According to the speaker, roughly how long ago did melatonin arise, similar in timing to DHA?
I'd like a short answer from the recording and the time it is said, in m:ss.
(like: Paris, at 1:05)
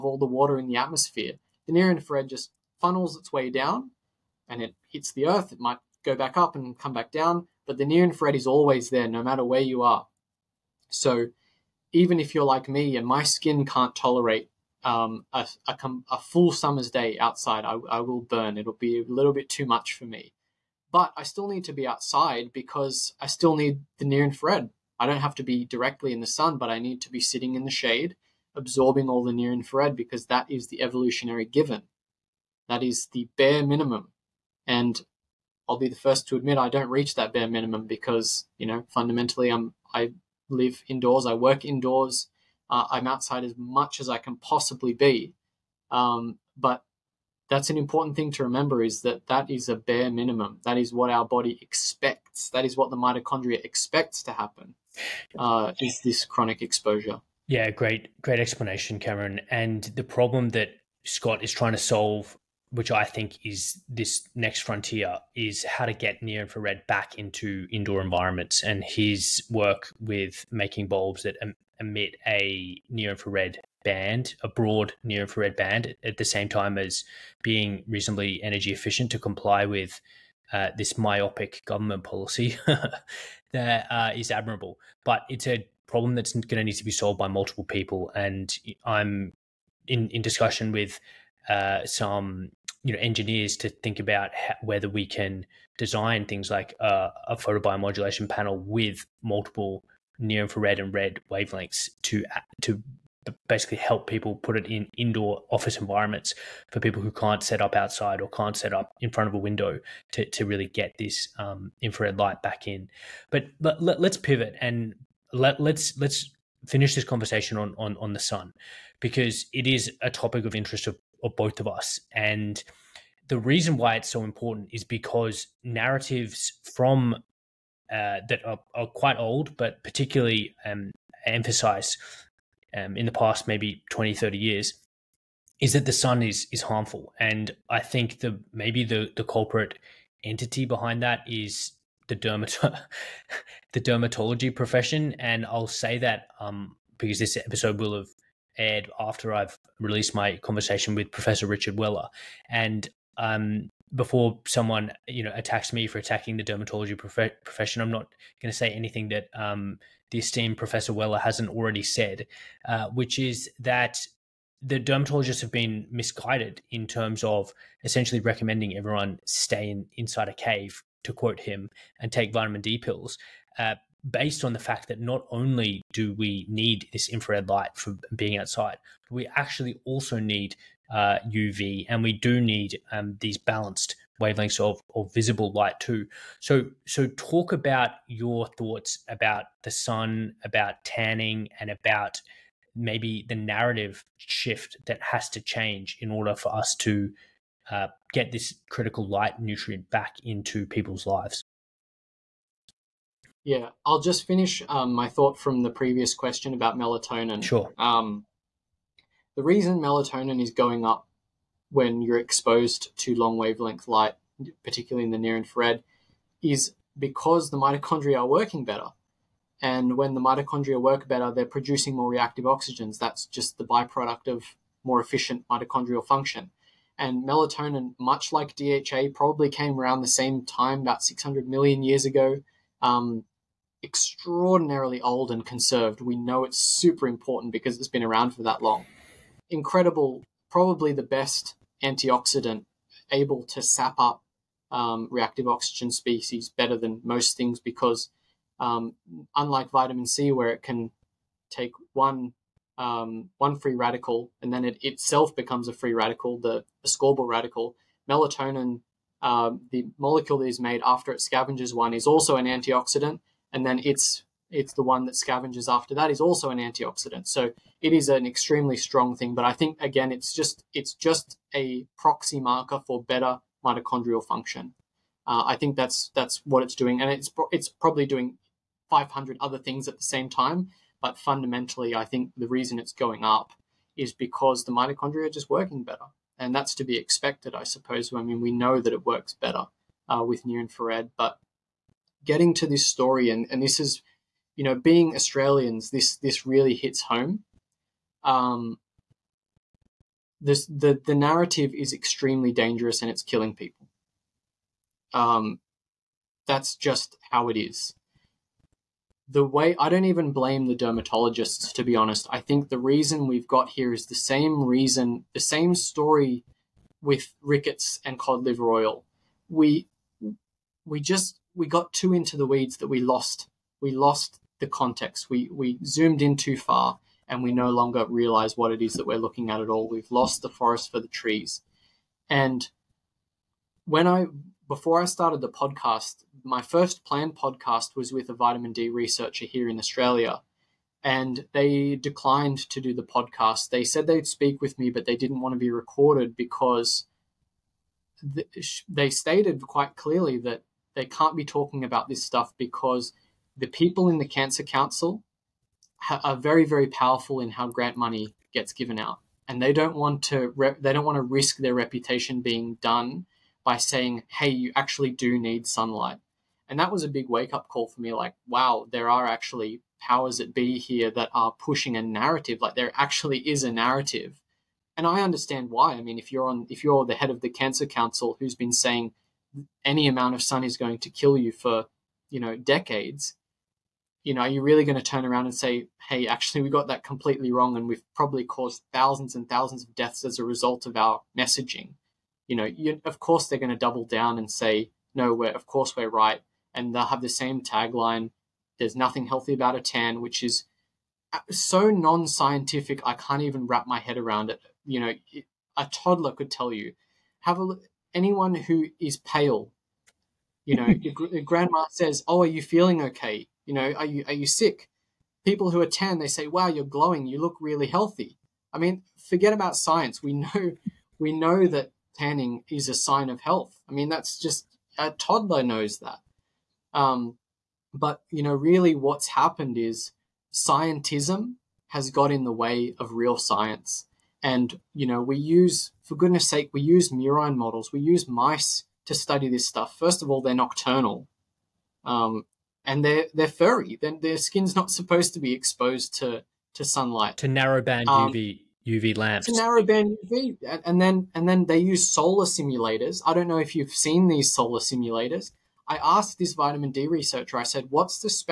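600 million years ago, at 3:51.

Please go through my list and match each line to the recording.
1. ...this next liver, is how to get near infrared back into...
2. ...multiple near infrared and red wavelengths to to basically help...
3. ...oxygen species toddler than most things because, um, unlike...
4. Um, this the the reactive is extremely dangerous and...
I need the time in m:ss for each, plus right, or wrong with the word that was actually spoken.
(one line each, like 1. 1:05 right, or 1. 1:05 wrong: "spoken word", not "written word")
1. 1:03 wrong: "frontier", not "liver"
2. 1:39 right
3. 4:05 wrong: "better", not "toddler"
4. 4:58 wrong: "narrative", not "reactive".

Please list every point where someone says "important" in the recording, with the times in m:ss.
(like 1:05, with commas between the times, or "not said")
0:47, 2:04, 3:57.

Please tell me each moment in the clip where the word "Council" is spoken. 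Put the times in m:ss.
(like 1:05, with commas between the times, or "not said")
5:54, 6:17.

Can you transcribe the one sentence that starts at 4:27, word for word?
So it is an extremely strong thing.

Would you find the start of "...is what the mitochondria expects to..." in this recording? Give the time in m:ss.
0:52.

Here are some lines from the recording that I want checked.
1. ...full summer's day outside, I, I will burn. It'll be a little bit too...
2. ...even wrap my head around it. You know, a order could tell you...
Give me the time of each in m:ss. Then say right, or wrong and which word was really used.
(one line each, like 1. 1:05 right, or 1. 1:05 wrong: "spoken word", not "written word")
1. 0:16 right
2. 6:43 wrong: "toddler", not "order".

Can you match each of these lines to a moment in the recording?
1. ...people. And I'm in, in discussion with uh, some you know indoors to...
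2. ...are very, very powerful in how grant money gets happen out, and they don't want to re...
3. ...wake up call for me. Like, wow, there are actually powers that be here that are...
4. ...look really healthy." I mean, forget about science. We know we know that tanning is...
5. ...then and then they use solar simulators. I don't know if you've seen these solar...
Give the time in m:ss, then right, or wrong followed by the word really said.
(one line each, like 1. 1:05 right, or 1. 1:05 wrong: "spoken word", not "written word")
1. 1:27 wrong: "engineers", not "indoors"
2. 5:56 wrong: "given", not "happen"
3. 6:07 right
4. 6:57 right
5. 7:31 right.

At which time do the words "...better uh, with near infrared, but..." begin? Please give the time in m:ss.
4:49.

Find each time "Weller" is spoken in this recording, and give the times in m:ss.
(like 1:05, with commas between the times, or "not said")
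2:31, 2:40.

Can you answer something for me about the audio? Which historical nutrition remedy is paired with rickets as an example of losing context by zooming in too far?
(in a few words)
Cod liver oil.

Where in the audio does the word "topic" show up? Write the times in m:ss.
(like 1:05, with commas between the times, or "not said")
2:00.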